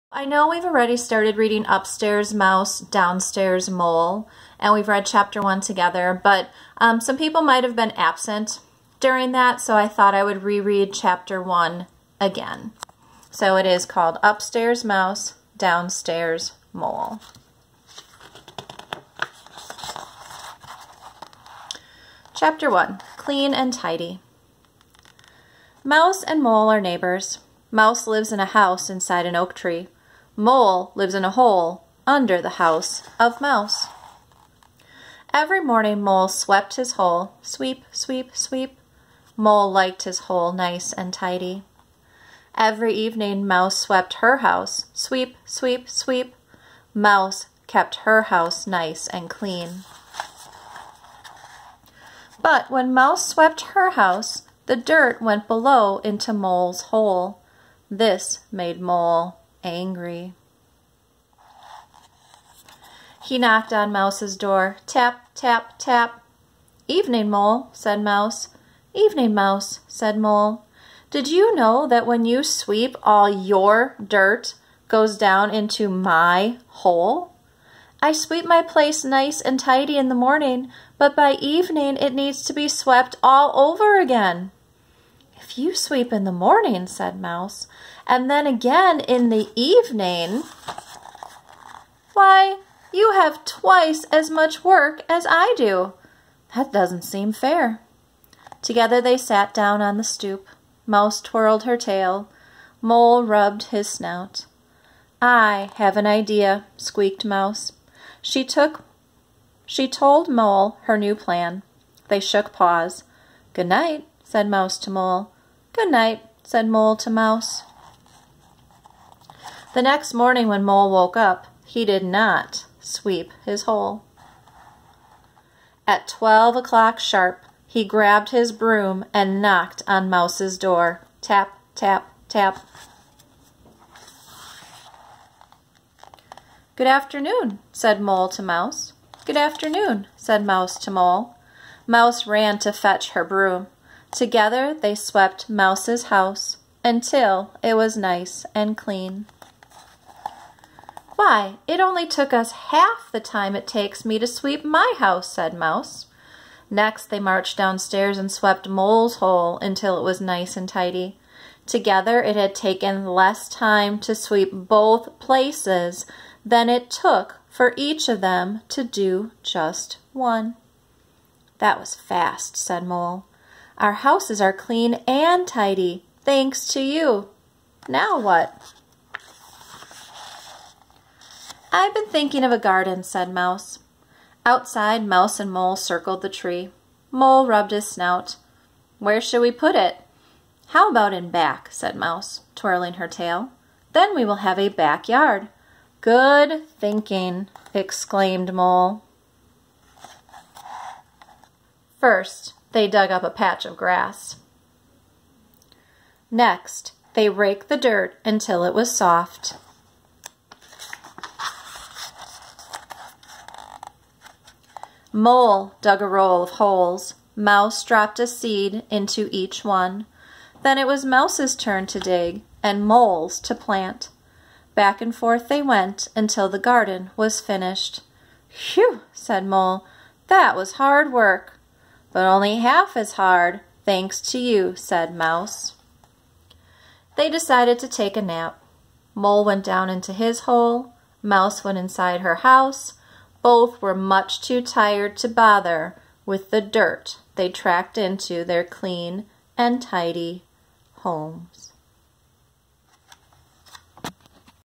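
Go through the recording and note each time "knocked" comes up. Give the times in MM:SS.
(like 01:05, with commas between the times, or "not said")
01:03, 02:09.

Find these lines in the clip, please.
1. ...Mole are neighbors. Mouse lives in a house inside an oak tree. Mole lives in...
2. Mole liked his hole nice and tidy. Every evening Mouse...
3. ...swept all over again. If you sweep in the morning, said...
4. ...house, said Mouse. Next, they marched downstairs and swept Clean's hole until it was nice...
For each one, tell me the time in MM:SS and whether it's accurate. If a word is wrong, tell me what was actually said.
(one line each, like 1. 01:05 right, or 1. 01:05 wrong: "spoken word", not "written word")
1. 00:26 right
2. 00:39 right
3. 01:22 right
4. 02:34 wrong: "Mole", not "Clean".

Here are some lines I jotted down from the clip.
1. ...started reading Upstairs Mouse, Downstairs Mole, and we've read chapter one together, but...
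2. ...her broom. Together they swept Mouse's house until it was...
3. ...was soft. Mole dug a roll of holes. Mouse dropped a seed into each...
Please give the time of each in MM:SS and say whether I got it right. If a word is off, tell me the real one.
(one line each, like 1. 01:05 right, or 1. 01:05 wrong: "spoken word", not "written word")
1. 00:00 right
2. 02:23 right
3. 03:28 right.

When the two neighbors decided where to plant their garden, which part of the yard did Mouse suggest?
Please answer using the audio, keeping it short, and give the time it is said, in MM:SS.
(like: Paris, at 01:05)
In back, at 03:11.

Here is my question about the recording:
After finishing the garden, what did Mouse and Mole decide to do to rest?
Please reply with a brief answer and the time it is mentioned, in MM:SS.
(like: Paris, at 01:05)
Take a nap, at 03:57.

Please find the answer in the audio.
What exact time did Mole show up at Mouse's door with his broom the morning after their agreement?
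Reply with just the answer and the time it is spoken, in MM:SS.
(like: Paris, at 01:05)
12 o'clock, at 02:06.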